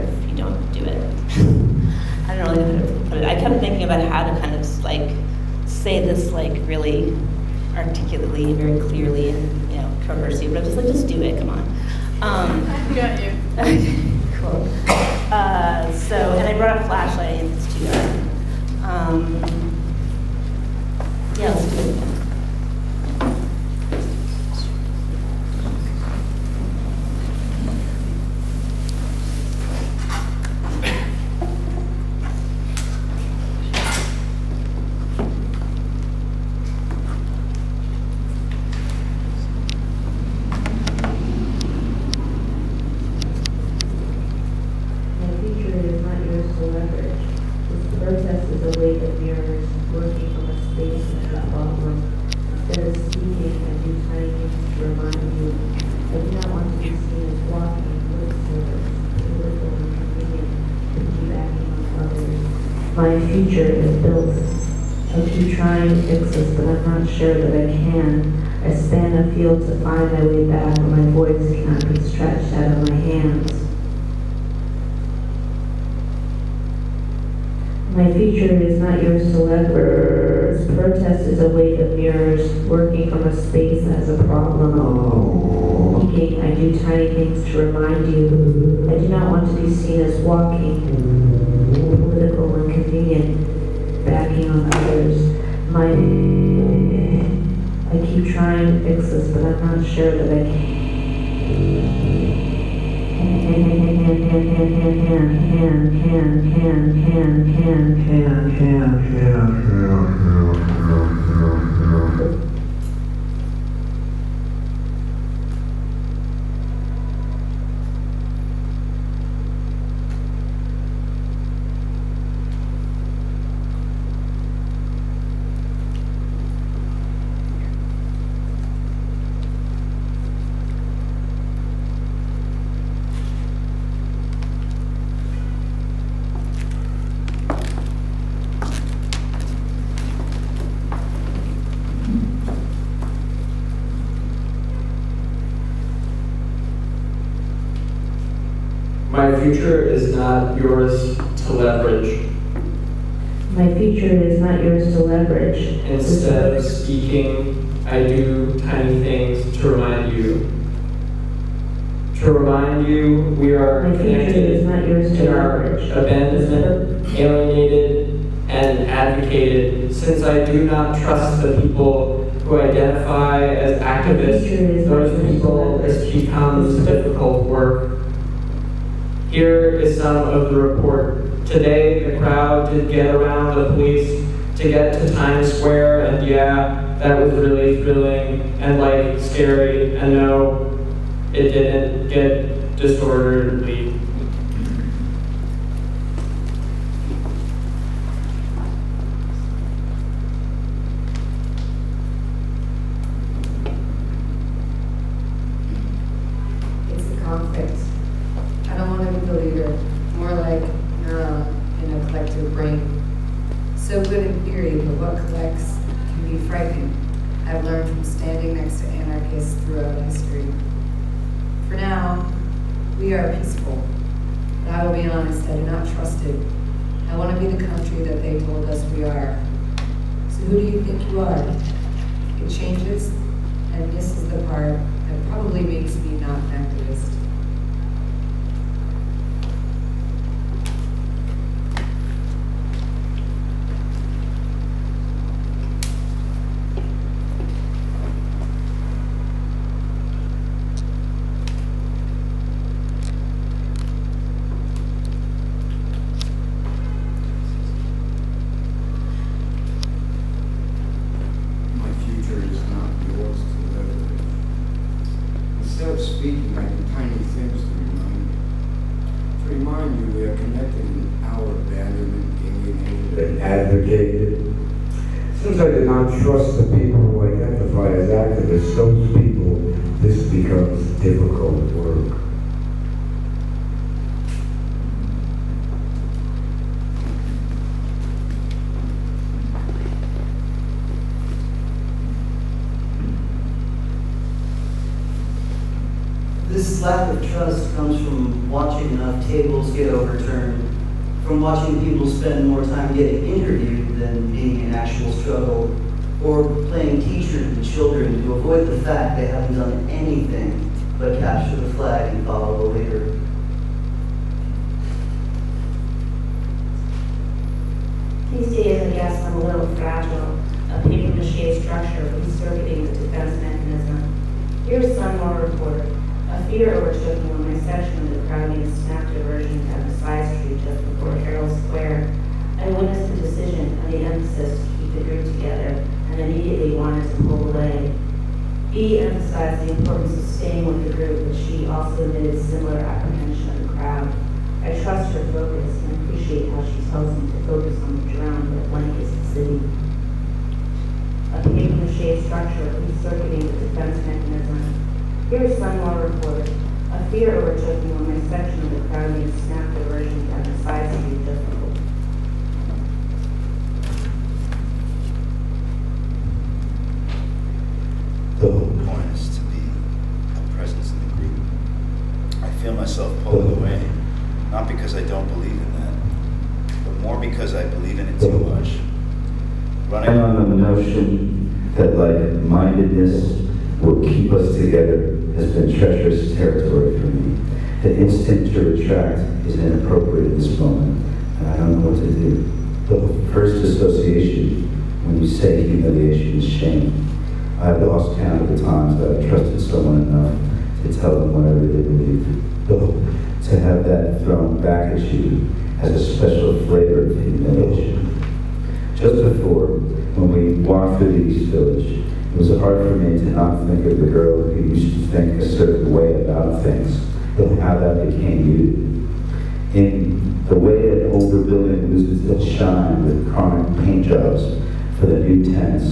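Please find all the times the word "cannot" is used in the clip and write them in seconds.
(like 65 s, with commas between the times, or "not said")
71 s.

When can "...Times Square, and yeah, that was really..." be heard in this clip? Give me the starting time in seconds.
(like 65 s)
185 s.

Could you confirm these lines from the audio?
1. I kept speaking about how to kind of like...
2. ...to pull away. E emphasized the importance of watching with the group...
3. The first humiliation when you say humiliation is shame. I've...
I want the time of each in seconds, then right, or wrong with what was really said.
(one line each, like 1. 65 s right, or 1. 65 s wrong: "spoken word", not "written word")
1. 3 s wrong: "thinking", not "speaking"
2. 337 s wrong: "staying", not "watching"
3. 392 s wrong: "association", not "humiliation".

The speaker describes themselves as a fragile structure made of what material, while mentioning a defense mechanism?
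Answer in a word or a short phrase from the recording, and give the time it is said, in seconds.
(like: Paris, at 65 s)
Paper mache, at 320 s.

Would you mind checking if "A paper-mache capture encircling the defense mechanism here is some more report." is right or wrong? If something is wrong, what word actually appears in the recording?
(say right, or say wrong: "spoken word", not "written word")
wrong: "structure", not "capture".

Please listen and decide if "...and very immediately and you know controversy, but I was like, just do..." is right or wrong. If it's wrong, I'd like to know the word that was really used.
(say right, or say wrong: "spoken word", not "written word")
wrong: "clearly", not "immediately".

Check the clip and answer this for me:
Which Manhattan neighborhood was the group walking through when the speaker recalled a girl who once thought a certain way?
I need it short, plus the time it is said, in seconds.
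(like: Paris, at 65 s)
East Village, at 411 s.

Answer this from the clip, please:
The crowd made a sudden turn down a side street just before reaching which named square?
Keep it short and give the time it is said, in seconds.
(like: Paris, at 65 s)
Herald Square, at 331 s.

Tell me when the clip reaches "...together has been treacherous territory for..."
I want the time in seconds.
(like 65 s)
384 s.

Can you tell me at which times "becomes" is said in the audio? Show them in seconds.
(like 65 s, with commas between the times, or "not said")
176 s, 280 s.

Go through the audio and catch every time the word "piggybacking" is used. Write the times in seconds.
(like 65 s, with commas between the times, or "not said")
60 s.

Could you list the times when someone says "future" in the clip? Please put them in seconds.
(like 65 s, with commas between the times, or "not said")
63 s, 78 s, 149 s, 153 s.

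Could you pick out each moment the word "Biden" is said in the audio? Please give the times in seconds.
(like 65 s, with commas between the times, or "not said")
not said.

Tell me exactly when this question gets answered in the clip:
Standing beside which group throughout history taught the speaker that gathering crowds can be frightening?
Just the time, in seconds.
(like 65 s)
218 s.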